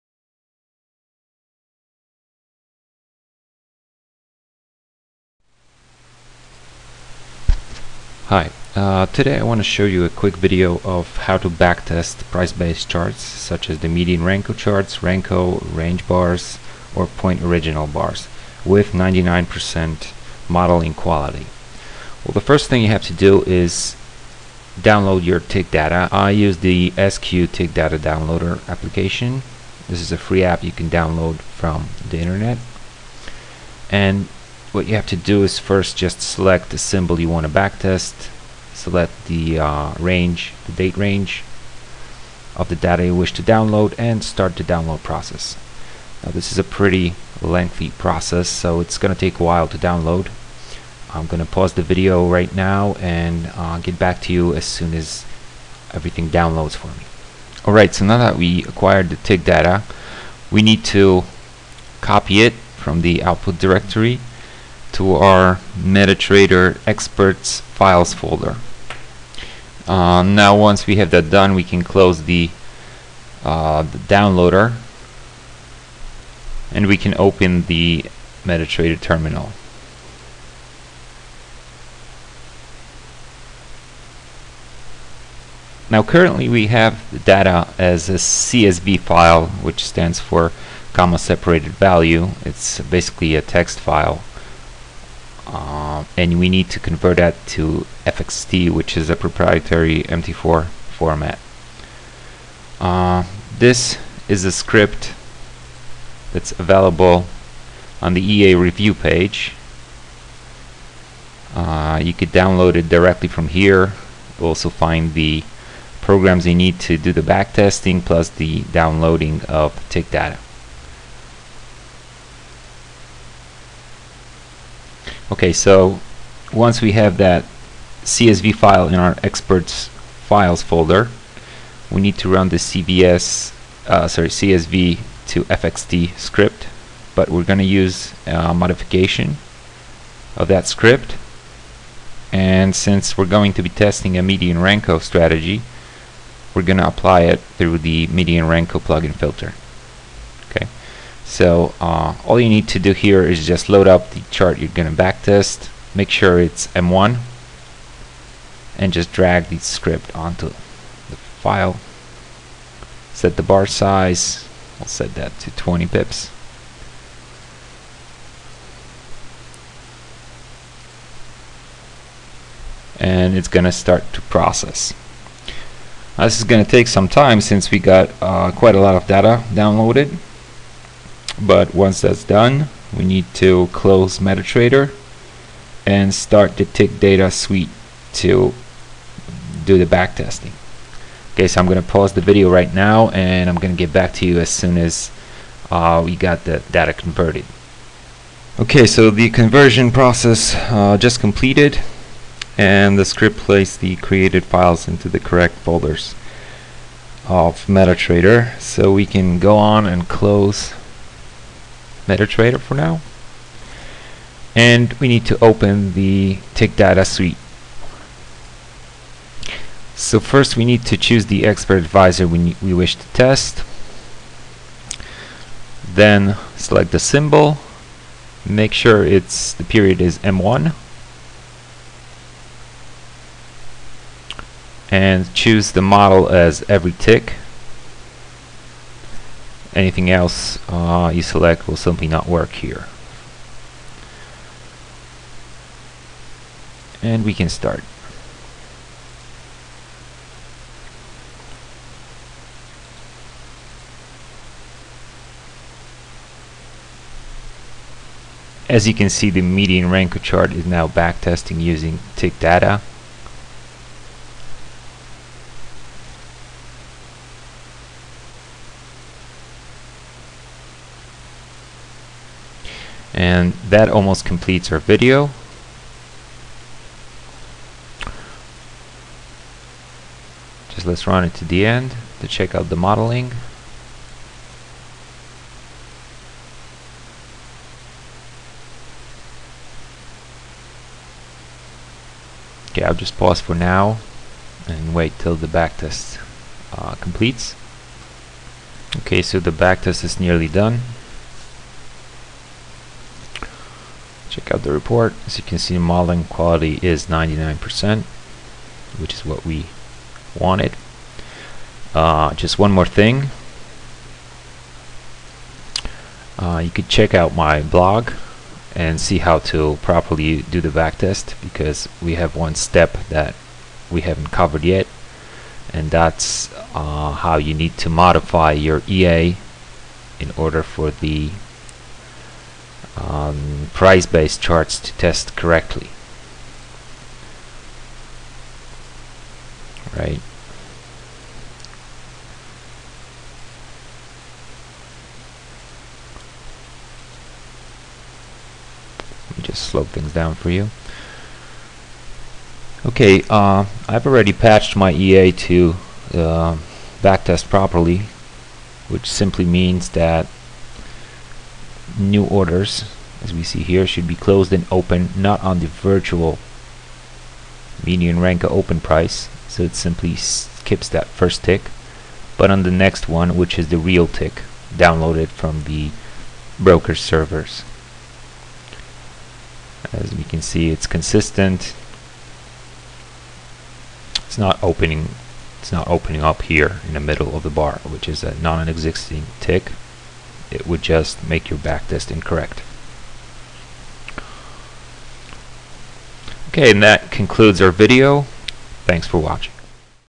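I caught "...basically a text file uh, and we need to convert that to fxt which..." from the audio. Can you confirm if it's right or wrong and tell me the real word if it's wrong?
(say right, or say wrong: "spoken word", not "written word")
right.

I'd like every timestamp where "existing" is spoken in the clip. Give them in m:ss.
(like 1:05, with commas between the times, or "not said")
6:28.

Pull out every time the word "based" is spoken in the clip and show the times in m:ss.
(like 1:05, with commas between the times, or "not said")
0:12, 5:33.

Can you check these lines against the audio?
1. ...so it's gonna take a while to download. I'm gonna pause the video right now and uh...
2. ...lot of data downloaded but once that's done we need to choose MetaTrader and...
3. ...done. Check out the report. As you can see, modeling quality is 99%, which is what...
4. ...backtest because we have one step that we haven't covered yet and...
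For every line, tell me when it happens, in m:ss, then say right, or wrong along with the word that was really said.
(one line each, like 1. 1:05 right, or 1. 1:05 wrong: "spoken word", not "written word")
1. 0:48 right
2. 2:58 wrong: "close", not "choose"
3. 5:00 right
4. 5:20 right.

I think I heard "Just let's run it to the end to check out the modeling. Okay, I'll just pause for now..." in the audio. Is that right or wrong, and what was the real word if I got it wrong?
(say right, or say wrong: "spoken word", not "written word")
right.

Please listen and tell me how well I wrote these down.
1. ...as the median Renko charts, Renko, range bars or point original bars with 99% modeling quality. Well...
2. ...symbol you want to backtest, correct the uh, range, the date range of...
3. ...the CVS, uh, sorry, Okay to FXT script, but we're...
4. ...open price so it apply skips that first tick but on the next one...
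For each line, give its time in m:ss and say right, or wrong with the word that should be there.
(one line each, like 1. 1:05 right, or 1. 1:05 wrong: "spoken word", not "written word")
1. 0:13 right
2. 0:36 wrong: "select", not "correct"
3. 2:12 wrong: "CSV", not "Okay"
4. 6:08 wrong: "simply", not "apply".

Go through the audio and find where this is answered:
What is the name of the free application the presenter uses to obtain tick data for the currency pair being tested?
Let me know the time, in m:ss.
0:26.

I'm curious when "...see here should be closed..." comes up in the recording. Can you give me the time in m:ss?
6:03.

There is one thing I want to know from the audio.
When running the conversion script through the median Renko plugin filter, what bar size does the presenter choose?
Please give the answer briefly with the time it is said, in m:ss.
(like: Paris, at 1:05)
20 pips, at 2:45.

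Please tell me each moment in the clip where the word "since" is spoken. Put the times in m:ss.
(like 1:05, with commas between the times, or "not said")
2:22, 2:57.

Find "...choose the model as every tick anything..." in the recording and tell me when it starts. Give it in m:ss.
3:55.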